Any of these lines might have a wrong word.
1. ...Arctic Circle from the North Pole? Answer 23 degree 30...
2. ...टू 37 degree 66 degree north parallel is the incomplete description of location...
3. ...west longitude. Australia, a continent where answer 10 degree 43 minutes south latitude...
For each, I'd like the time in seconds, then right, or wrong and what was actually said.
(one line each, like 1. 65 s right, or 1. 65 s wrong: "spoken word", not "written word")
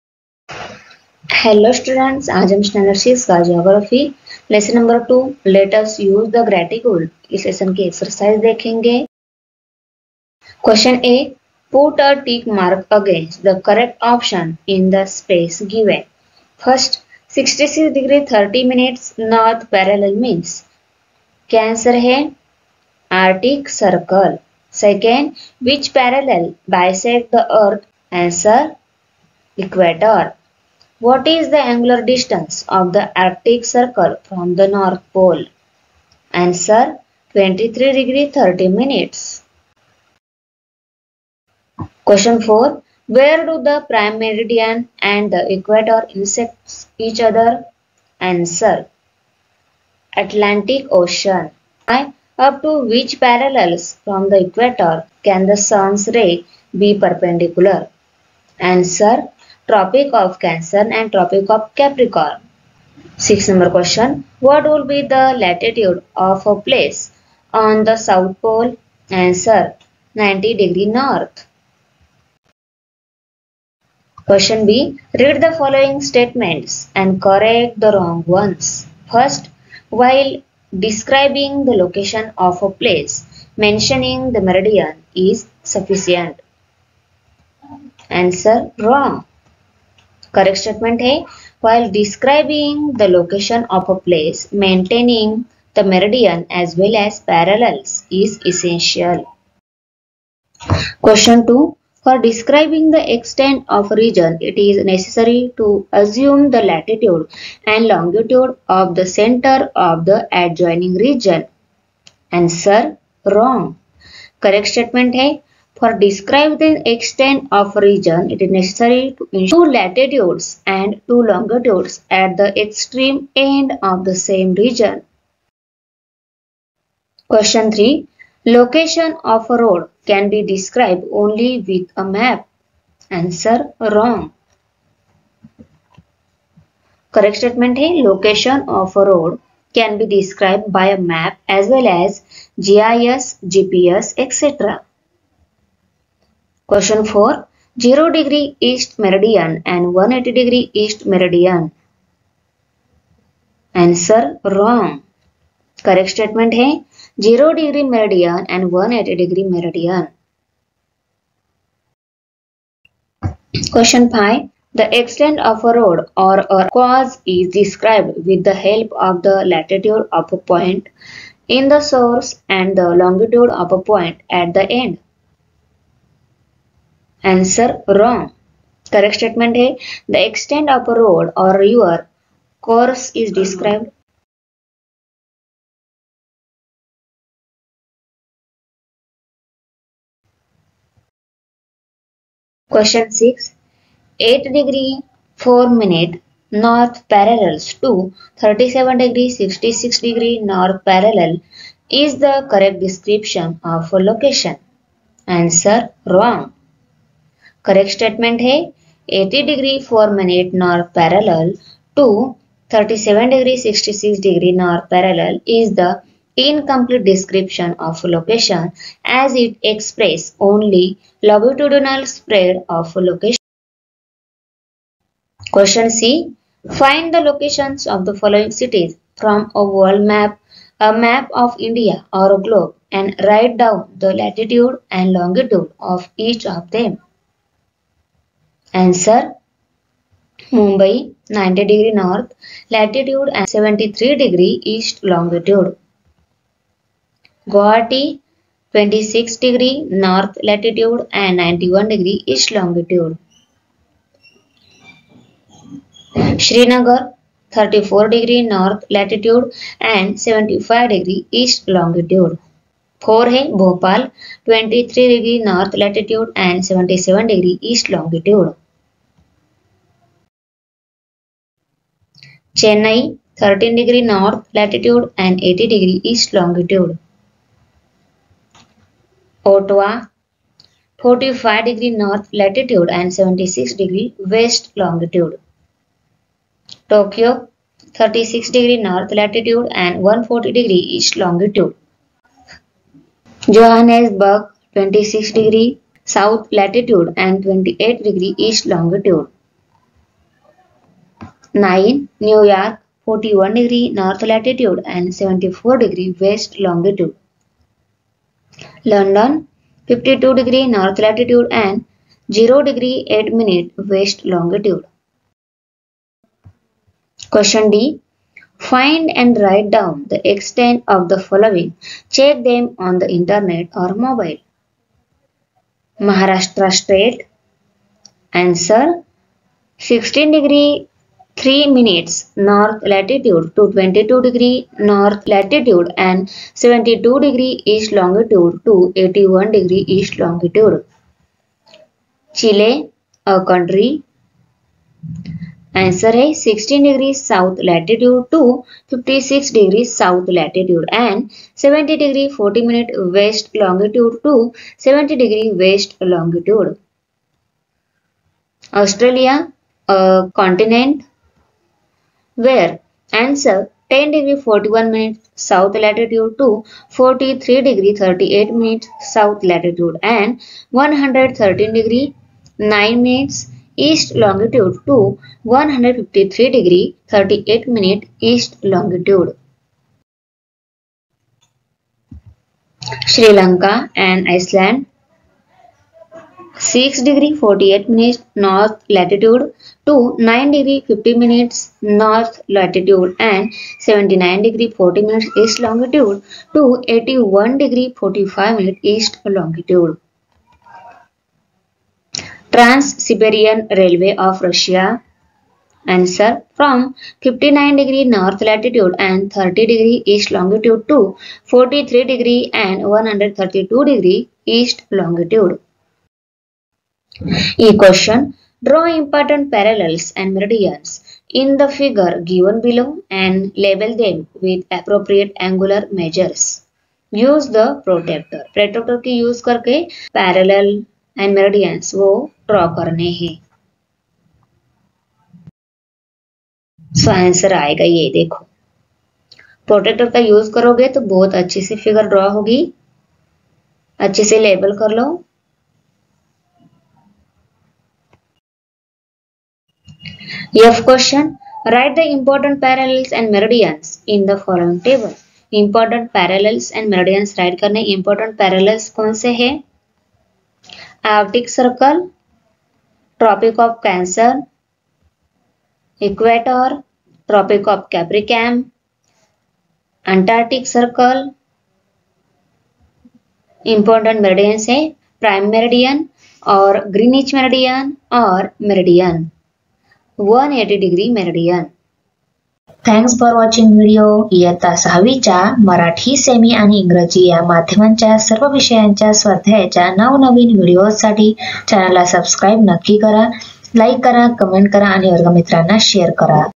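1. 33 s right
2. 211 s right
3. 355 s wrong: "41", not "43".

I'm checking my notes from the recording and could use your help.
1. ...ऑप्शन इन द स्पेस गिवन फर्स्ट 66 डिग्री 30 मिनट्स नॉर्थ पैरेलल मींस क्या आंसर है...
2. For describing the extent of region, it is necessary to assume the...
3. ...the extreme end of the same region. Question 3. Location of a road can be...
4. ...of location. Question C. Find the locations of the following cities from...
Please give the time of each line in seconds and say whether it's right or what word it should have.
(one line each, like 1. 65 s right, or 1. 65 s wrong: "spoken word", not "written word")
1. 14 s right
2. 102 s right
3. 122 s right
4. 222 s right.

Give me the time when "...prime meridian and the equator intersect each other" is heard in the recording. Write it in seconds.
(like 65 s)
43 s.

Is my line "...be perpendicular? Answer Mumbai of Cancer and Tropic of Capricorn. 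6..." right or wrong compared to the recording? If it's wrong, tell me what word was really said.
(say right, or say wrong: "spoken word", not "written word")
wrong: "Tropic", not "Mumbai".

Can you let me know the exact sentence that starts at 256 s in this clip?
Srinagar 34 degree north latitude and 75 degree east longitude.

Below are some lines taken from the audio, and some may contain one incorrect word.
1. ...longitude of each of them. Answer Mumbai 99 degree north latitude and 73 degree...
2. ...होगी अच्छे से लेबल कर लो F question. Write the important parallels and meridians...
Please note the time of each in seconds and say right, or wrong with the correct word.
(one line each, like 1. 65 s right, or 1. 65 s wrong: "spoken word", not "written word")
1. 235 s wrong: "90", not "99"
2. 442 s right.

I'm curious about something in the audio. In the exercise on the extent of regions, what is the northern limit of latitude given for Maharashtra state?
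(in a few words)
22 degree north.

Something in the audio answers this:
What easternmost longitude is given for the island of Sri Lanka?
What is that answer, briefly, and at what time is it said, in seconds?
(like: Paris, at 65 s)
81 degree 45 minutes east, at 396 s.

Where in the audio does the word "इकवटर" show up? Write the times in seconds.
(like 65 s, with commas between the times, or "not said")
29 s, 466 s.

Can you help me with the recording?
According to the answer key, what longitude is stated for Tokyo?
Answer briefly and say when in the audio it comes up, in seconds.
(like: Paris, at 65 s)
140 degree east, at 290 s.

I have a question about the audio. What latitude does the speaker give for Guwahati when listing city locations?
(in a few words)
26 degree north.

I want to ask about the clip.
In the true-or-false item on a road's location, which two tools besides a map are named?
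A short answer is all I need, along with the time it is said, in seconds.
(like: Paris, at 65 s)
GIS, GPS, at 142 s.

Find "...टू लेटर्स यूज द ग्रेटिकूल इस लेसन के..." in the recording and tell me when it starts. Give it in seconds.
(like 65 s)
5 s.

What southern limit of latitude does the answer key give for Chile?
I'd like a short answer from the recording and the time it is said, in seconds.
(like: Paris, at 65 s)
56 degrees south, at 348 s.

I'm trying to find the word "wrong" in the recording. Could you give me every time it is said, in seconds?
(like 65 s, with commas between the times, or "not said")
77 s, 88 s, 113 s, 133 s, 154 s, 177 s, 206 s.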